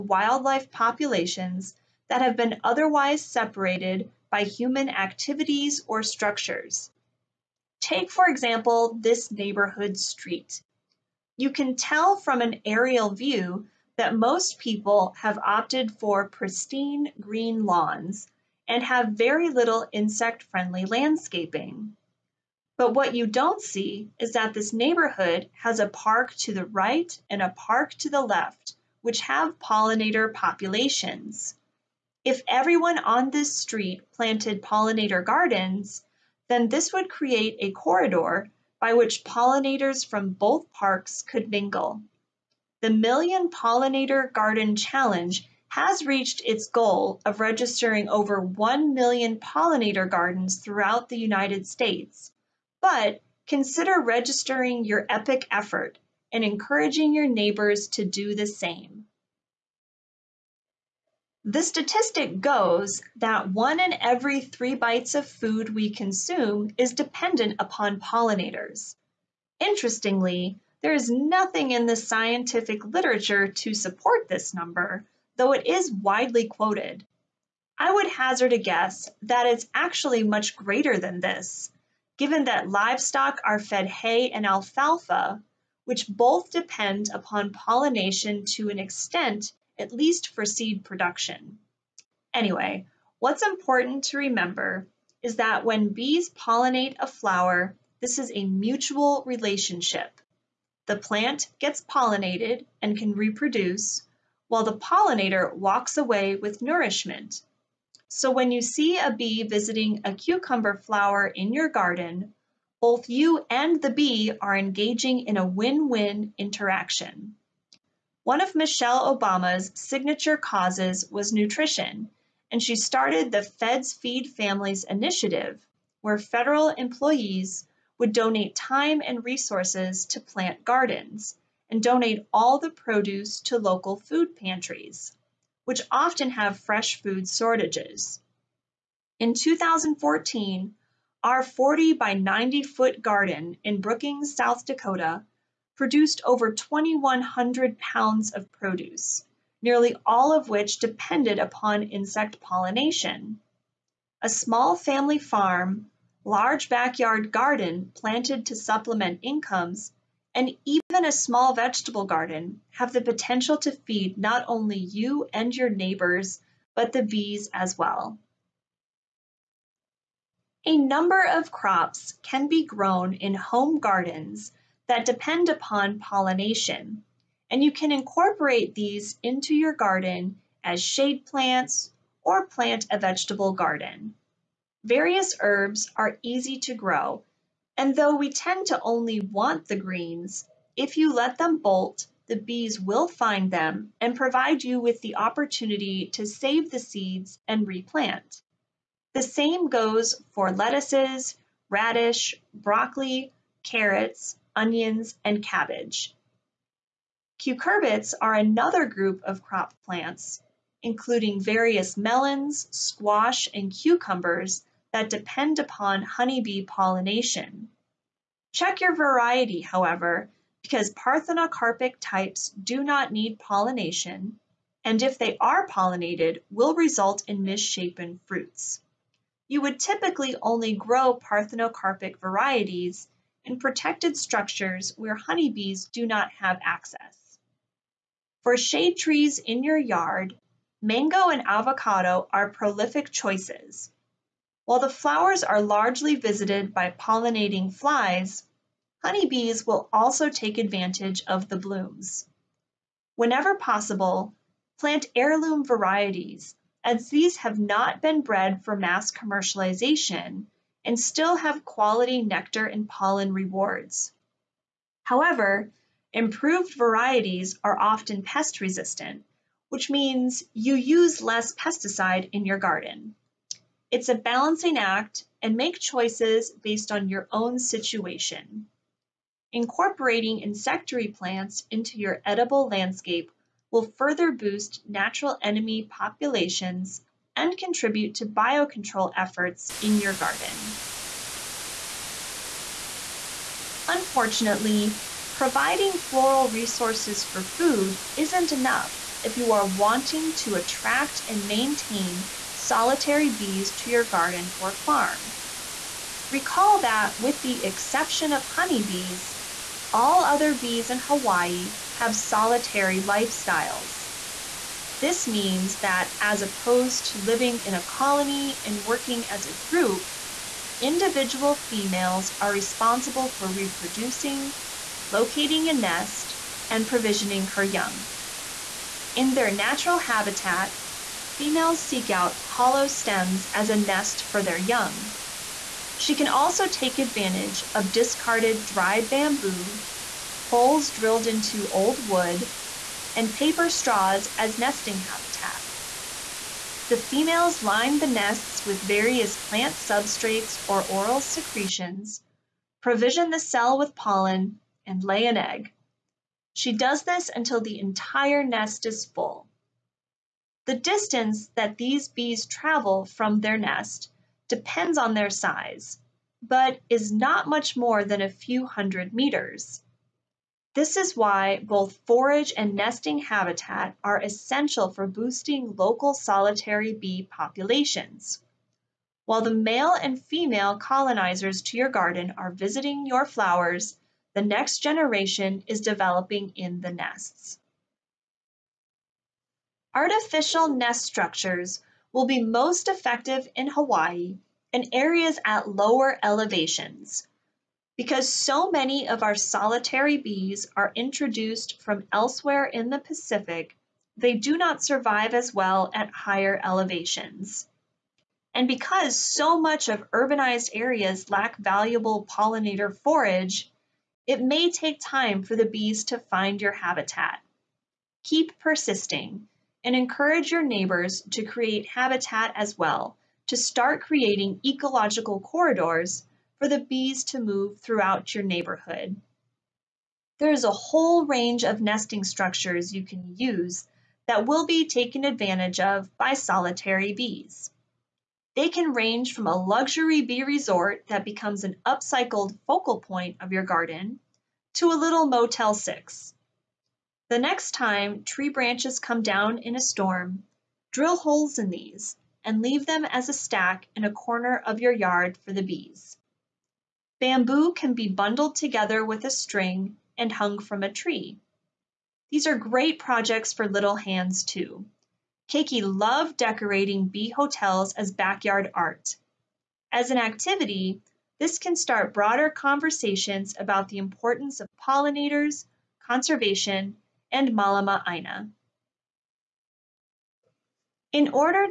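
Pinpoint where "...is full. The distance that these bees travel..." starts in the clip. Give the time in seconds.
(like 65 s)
358 s.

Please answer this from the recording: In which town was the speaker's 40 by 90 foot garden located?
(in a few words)
Brookings, South Dakota.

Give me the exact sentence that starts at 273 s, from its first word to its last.
It's a balancing act and make choices based on your own situation.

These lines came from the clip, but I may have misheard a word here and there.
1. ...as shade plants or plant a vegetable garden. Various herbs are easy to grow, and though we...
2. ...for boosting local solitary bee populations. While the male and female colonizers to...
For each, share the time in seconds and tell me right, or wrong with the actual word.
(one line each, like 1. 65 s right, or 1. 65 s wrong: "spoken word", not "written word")
1. 180 s right
2. 374 s right.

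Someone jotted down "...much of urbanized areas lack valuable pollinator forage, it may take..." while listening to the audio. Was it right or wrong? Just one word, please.
right.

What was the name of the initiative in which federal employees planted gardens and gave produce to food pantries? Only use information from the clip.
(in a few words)
Feds Feed Families.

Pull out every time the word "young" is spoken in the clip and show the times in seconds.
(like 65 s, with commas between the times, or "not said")
327 s, 334 s.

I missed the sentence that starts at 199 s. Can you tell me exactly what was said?
The same goes for lettuces, radish, broccoli, carrots, onions, and cabbage.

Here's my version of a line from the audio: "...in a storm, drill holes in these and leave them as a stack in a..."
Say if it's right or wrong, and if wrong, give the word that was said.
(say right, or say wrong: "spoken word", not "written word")
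right.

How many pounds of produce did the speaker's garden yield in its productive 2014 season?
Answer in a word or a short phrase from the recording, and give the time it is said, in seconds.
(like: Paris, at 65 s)
2,100, at 146 s.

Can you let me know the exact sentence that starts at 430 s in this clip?
There is a whole range of nesting structures you can use that will be taken advantage of by solitary bees.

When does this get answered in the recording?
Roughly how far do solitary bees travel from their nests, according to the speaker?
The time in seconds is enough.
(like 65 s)
368 s.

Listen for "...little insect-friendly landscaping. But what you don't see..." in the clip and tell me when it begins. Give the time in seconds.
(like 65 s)
19 s.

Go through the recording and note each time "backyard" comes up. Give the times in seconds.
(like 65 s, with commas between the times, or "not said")
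156 s, 468 s.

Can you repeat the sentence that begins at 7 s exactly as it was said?
Take, for example, this neighborhood street.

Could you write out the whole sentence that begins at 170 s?
A number of crops can be grown in home gardens that depend upon pollination.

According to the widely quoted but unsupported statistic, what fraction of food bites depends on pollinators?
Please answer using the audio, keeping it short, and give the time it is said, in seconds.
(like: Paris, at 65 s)
1 in 3, at 63 s.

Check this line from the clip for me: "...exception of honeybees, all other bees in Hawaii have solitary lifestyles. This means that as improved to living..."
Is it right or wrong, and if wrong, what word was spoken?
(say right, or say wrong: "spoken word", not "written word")
wrong: "opposed", not "improved".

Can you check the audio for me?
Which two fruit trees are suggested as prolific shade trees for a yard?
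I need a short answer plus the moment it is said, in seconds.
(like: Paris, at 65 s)
mango and avocado, at 240 s.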